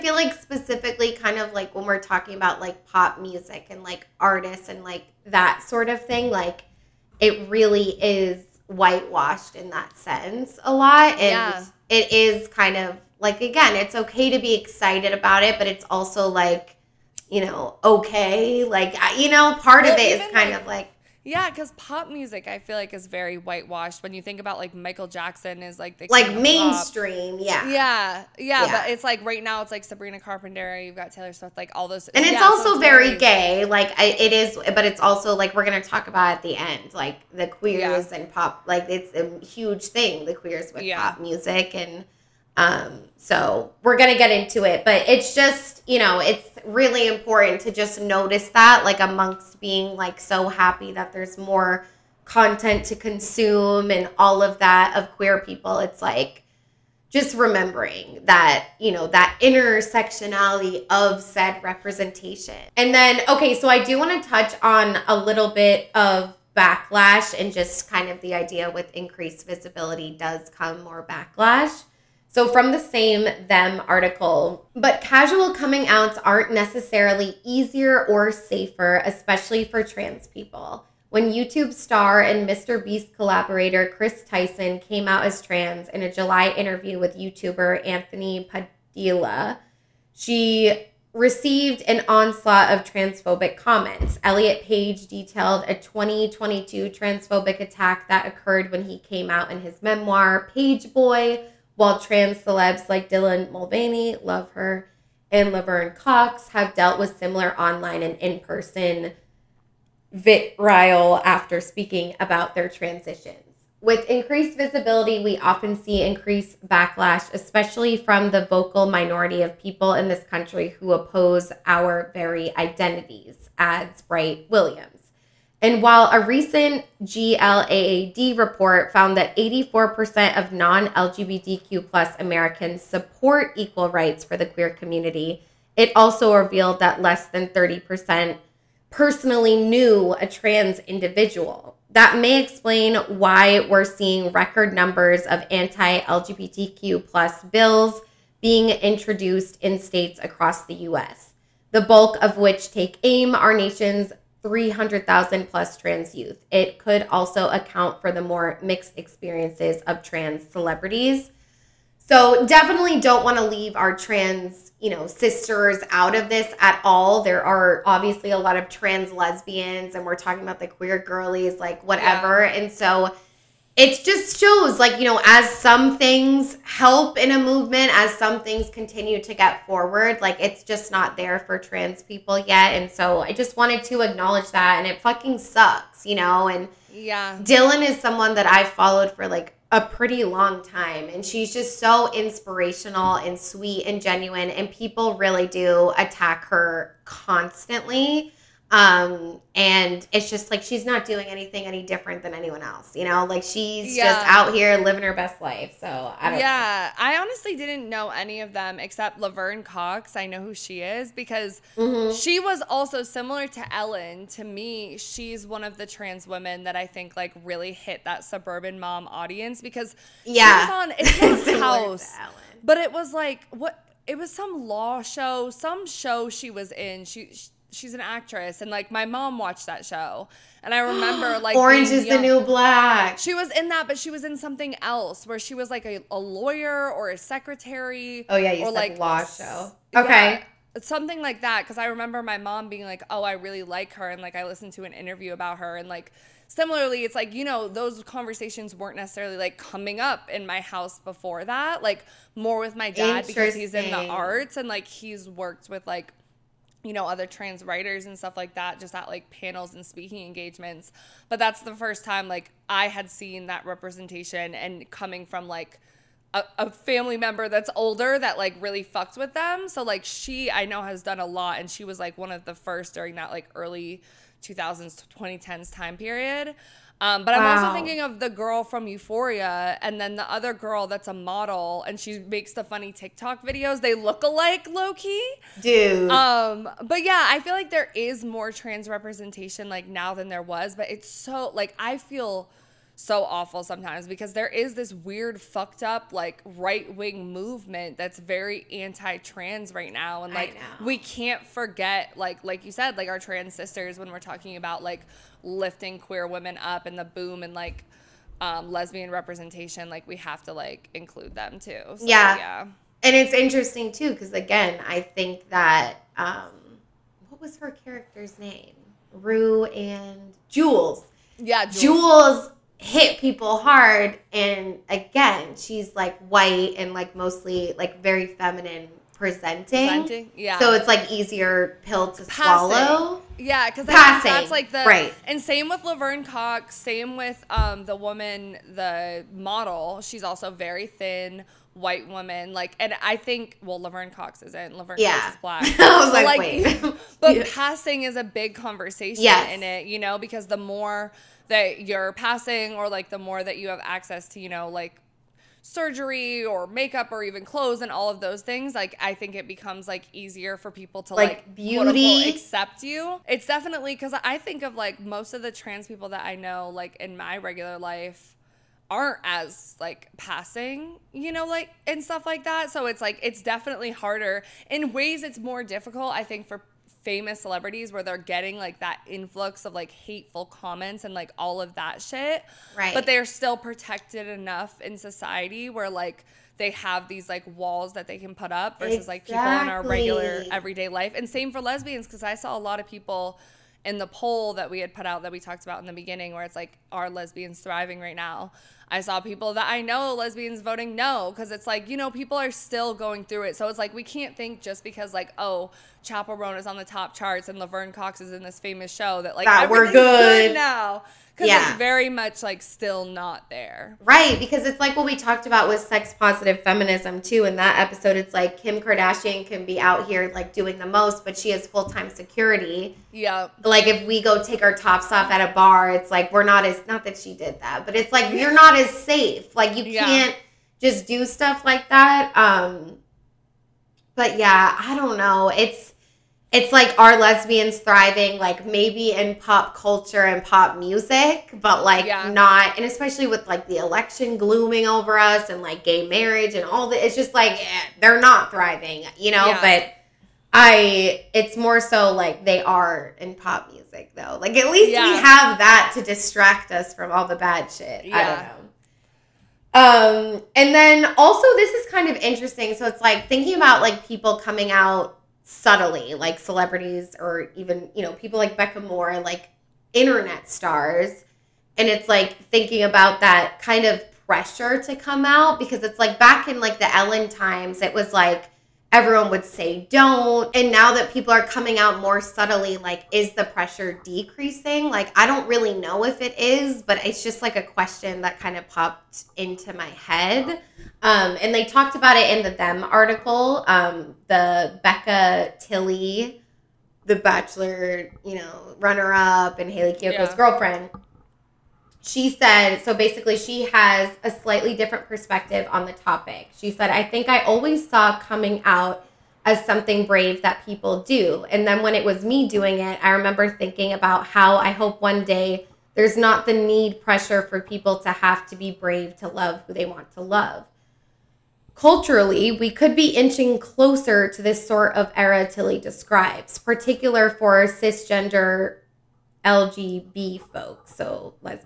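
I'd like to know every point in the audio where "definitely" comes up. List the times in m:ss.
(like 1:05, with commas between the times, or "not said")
2:42, 6:03, 6:13.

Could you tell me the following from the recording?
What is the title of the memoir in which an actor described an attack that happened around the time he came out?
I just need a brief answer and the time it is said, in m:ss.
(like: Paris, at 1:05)
Page Boy, at 1:40.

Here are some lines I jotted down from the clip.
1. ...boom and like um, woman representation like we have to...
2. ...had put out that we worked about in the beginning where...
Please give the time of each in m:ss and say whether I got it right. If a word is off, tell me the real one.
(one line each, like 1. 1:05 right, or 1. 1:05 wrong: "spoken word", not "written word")
1. 5:07 wrong: "lesbian", not "woman"
2. 6:34 wrong: "talked", not "worked".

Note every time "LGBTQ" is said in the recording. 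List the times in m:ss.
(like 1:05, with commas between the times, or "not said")
2:10, 2:26.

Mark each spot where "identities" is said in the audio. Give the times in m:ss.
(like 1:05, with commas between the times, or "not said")
2:02.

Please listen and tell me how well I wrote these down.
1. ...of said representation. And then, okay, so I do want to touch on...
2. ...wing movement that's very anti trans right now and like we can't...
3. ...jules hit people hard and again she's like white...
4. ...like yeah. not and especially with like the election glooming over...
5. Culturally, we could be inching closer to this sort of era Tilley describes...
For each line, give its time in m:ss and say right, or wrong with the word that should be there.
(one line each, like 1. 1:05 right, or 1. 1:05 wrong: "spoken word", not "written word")
1. 1:00 right
2. 4:56 right
3. 5:21 right
4. 7:21 right
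5. 8:41 right.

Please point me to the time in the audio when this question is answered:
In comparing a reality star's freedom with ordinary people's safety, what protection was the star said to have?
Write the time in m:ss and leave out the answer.
7:01.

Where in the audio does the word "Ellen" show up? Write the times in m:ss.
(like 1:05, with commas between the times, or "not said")
3:33, 7:56.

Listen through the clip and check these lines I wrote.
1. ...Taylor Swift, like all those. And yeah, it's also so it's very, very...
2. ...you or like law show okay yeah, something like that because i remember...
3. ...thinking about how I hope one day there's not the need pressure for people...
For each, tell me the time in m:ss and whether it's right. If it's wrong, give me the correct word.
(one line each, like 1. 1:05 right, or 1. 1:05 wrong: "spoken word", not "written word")
1. 0:31 right
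2. 3:58 right
3. 8:33 right.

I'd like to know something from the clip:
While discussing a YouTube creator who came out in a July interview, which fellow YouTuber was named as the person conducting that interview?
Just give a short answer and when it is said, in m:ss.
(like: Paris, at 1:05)
Anthony Padilla, at 1:27.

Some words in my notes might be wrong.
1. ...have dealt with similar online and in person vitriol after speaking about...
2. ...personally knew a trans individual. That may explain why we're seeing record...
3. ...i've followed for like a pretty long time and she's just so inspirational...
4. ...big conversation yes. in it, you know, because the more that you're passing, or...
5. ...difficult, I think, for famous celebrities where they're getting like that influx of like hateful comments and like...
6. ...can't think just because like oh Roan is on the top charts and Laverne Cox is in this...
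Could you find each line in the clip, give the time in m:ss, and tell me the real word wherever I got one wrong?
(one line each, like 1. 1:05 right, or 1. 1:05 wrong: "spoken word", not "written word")
1. 1:46 right
2. 2:18 right
3. 3:08 right
4. 5:48 right
5. 6:15 right
6. 6:44 right.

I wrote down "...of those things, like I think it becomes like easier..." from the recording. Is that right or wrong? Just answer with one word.
right.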